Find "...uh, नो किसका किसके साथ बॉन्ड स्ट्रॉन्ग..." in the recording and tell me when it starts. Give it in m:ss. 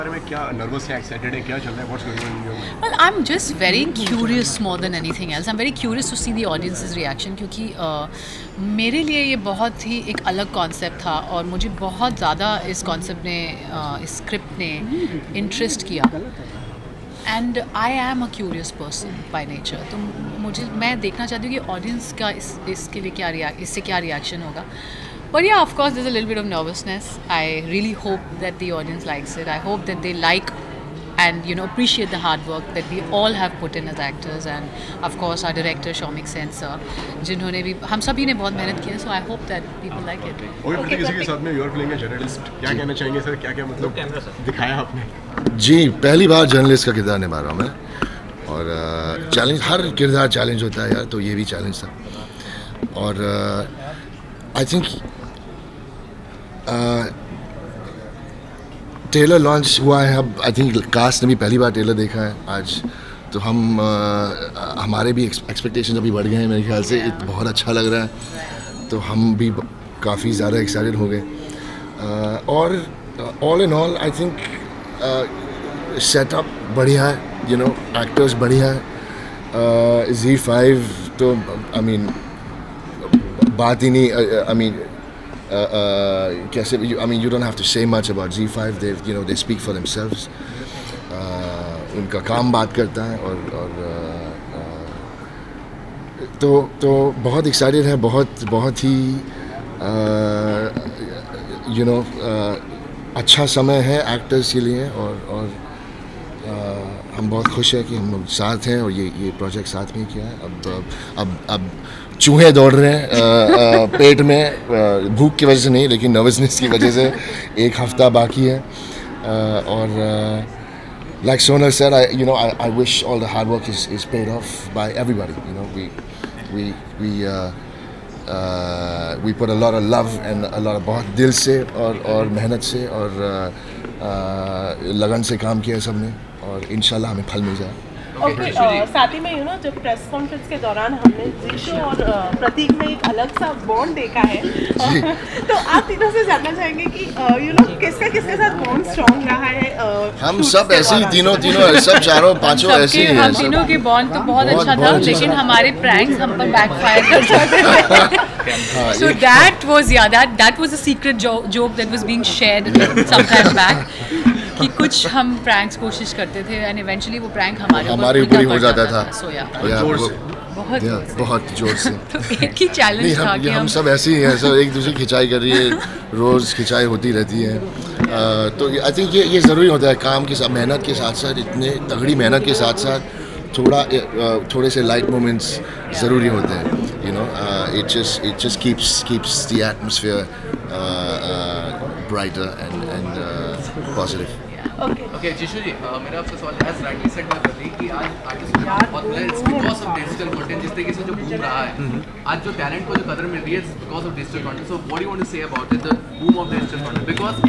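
2:27.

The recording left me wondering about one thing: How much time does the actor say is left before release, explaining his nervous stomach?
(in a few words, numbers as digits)
1 week.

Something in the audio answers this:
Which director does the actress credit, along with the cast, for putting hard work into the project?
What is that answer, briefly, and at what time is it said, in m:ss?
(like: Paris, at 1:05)
Shomik Sen, at 0:35.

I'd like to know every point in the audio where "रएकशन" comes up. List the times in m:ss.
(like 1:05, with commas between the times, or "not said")
0:06, 0:24.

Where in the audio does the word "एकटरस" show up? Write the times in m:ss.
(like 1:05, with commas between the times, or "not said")
1:18, 1:44.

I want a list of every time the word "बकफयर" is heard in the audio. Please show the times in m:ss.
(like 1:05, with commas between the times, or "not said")
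2:36.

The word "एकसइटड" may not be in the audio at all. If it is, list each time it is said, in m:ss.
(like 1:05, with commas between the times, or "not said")
0:00, 1:10, 1:37.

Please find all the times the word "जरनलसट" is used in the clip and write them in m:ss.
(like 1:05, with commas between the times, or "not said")
0:42, 0:46.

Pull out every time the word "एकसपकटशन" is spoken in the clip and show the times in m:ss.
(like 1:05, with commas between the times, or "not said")
1:05.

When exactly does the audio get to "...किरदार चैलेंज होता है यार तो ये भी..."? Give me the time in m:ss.
0:50.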